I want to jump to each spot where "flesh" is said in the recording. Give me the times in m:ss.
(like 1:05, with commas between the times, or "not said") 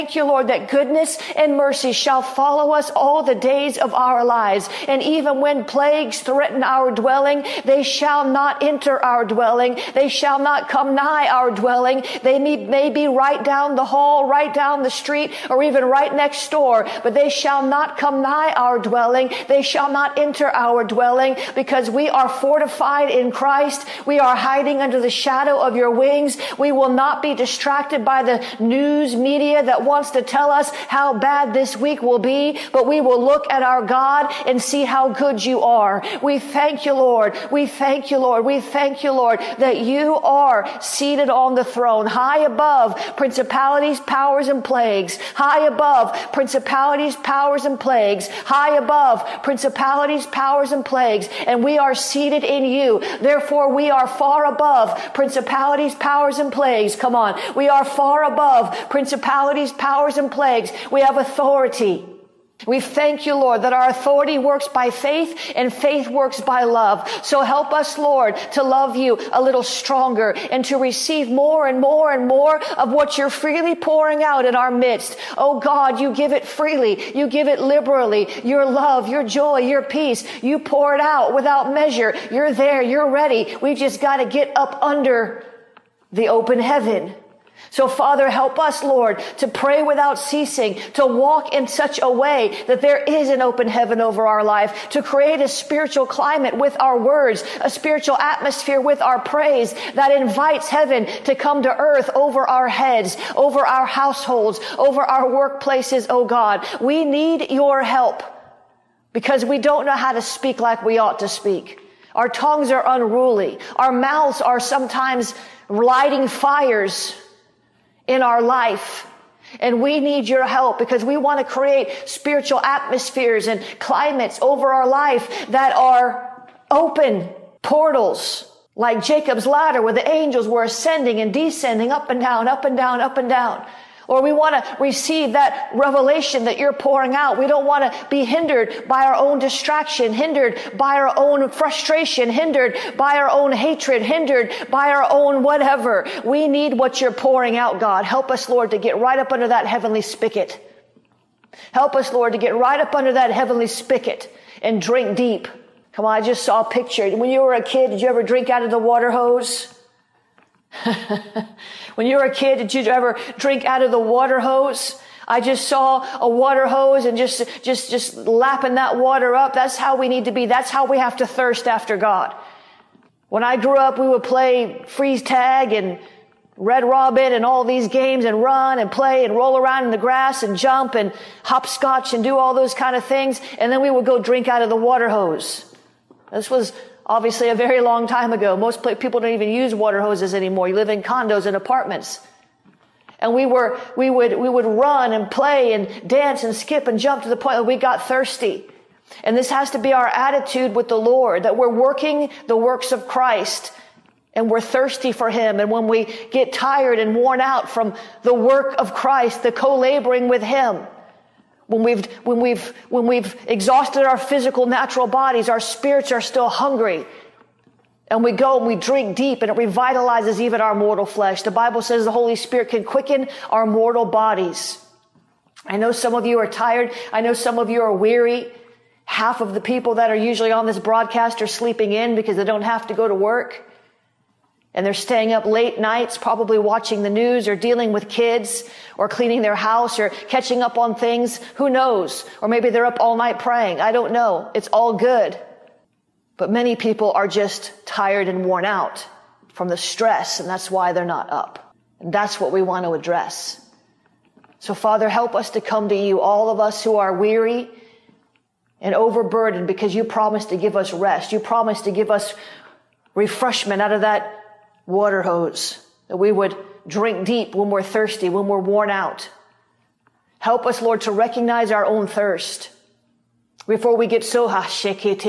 3:41.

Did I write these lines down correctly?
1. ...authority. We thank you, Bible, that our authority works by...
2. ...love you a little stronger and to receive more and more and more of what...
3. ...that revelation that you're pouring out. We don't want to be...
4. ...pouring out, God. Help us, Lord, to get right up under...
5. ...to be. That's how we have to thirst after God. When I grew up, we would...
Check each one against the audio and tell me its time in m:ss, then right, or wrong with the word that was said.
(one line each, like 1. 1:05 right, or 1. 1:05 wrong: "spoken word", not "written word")
1. 1:01 wrong: "Lord", not "Bible"
2. 1:08 right
3. 2:15 right
4. 2:27 right
5. 2:50 right.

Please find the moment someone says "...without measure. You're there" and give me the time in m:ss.
1:21.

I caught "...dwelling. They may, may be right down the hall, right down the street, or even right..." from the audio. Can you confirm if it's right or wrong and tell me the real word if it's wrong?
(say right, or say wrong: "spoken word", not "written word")
right.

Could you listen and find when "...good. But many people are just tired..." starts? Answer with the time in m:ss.
4:04.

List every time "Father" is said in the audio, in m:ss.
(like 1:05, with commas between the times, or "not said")
1:27, 4:14.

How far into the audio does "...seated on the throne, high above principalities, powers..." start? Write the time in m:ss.
0:40.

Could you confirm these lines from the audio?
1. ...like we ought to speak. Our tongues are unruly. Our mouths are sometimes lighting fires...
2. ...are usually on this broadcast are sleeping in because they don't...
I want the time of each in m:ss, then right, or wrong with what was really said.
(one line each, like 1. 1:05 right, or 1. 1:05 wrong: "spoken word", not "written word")
1. 1:50 right
2. 3:50 right.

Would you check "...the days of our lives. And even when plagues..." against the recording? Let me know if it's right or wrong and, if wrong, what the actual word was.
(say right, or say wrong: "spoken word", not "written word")
right.